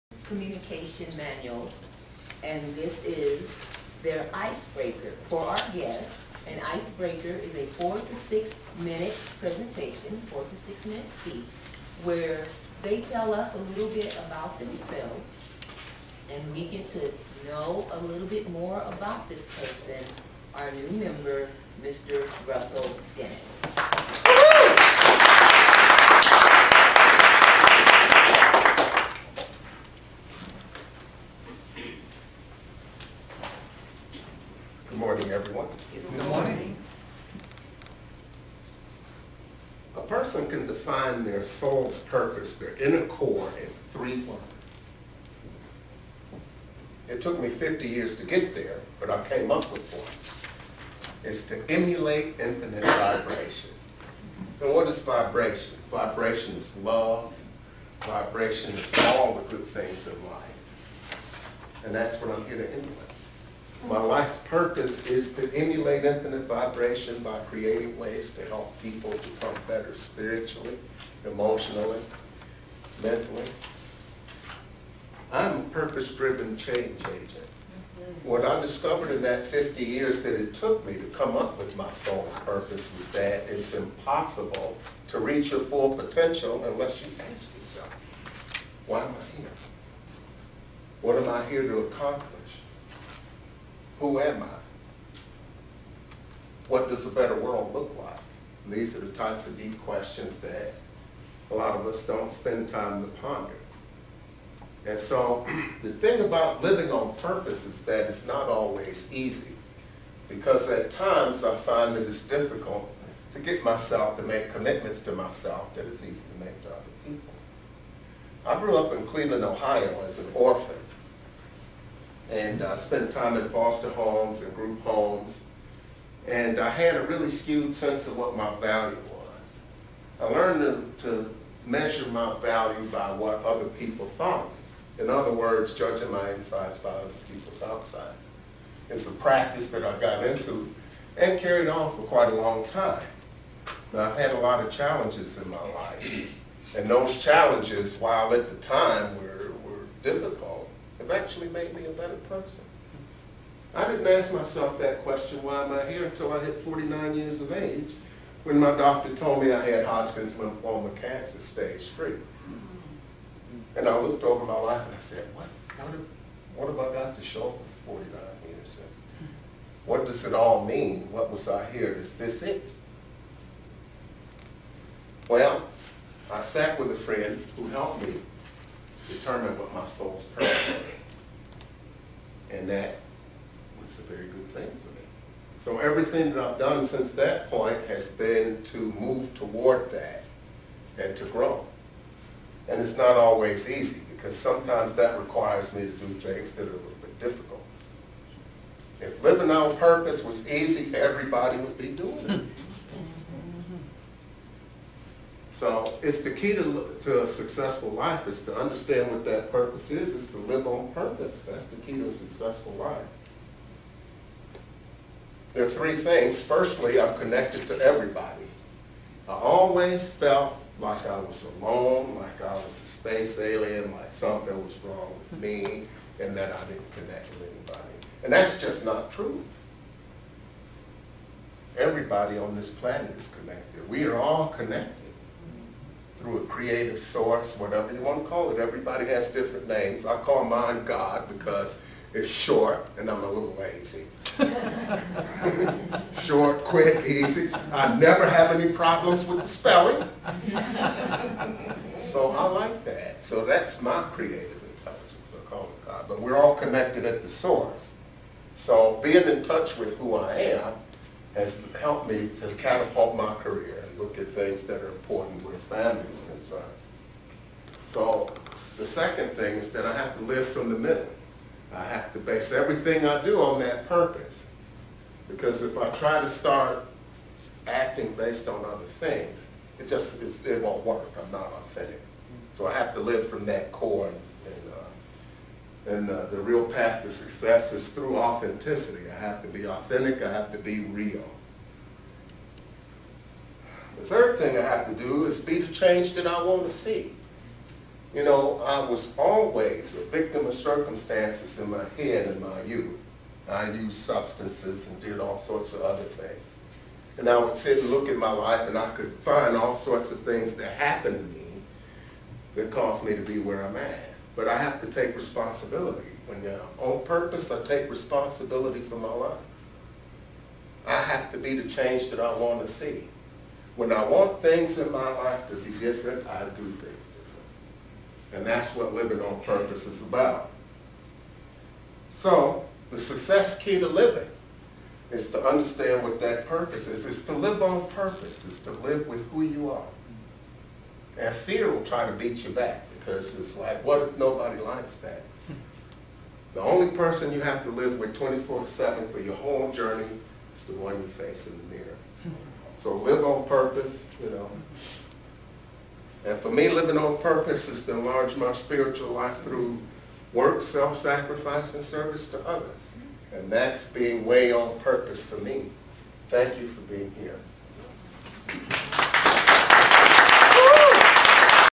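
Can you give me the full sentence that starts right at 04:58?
You know, I was always a victim of circumstances in my head in my youth.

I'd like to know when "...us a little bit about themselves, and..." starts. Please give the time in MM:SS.
00:13.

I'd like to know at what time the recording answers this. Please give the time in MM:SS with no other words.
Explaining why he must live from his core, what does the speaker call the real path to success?
04:48.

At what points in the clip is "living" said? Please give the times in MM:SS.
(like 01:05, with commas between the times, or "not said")
01:46, 03:19, 05:28, 05:33, 05:56.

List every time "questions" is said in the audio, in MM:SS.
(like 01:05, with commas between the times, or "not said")
01:39, 02:35.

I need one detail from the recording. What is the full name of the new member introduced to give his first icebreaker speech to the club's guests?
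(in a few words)
Russell Dennis.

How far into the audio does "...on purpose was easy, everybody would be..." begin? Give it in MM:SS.
03:19.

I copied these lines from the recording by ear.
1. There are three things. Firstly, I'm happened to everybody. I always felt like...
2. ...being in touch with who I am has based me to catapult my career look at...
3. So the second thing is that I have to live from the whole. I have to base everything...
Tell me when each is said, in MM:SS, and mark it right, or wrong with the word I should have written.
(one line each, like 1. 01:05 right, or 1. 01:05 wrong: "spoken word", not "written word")
1. 03:35 wrong: "connected", not "happened"
2. 04:19 wrong: "helped", not "based"
3. 04:27 wrong: "middle", not "whole".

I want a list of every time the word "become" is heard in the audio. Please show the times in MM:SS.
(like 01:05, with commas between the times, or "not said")
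01:09.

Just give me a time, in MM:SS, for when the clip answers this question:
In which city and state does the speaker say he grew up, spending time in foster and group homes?
01:59.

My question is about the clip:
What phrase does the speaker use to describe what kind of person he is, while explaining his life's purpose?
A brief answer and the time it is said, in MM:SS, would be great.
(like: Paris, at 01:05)
purpose-driven change agent, at 01:15.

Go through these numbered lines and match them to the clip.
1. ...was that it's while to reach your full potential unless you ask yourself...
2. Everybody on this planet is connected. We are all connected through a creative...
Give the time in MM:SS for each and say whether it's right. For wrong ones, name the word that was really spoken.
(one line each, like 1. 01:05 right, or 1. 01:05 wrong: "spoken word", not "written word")
1. 01:22 wrong: "impossible", not "while"
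2. 03:51 right.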